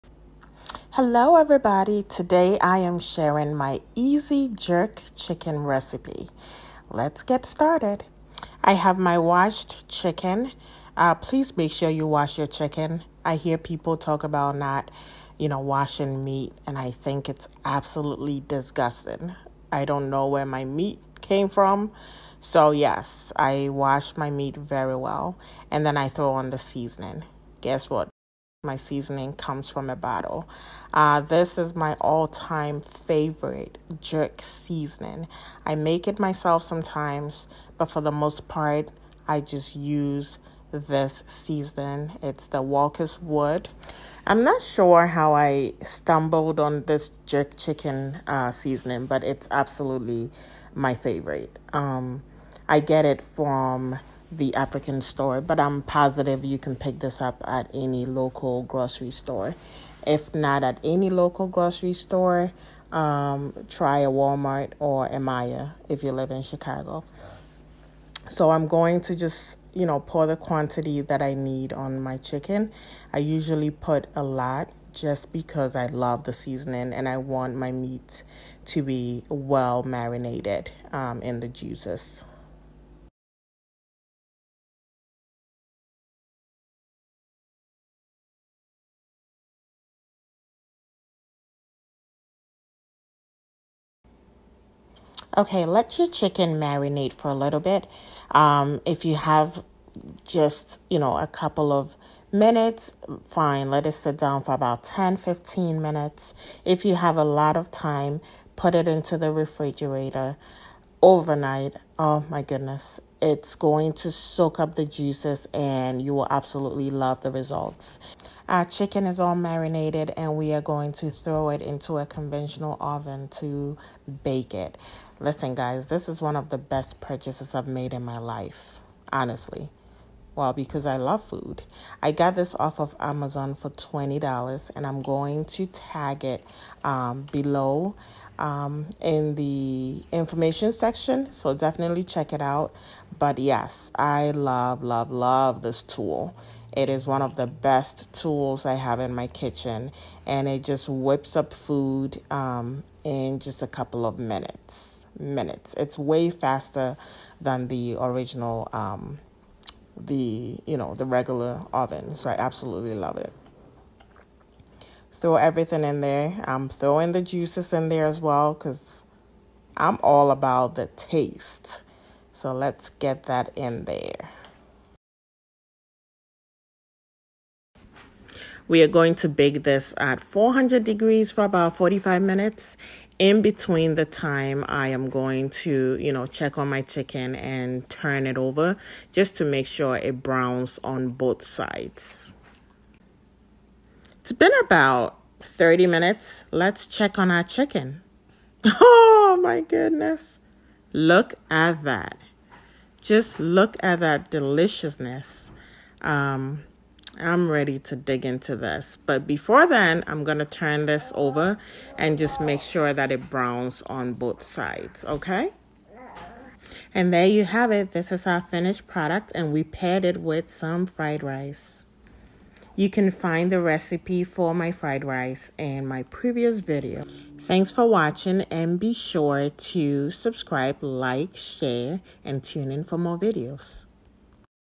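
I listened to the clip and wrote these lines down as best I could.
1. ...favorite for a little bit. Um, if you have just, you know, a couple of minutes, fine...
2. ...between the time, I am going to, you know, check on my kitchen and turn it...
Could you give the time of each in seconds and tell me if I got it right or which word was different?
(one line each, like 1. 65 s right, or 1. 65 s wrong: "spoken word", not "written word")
1. 96 s wrong: "marinate", not "favorite"
2. 183 s wrong: "chicken", not "kitchen".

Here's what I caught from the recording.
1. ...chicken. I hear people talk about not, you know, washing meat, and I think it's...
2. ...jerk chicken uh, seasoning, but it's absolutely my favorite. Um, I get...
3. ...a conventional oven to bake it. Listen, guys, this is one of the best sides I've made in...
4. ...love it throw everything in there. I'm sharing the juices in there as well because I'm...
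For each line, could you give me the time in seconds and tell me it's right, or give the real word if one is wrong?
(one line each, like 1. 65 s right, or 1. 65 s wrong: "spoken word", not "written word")
1. 12 s right
2. 47 s right
3. 121 s wrong: "purchases", not "sides"
4. 162 s wrong: "throwing", not "sharing".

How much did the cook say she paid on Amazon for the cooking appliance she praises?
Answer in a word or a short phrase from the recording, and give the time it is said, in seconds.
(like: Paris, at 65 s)
$20, at 133 s.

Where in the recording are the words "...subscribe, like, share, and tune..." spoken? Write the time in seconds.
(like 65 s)
230 s.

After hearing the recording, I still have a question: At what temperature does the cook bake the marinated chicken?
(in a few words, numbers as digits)
400 degrees.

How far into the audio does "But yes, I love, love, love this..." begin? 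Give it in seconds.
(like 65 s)
143 s.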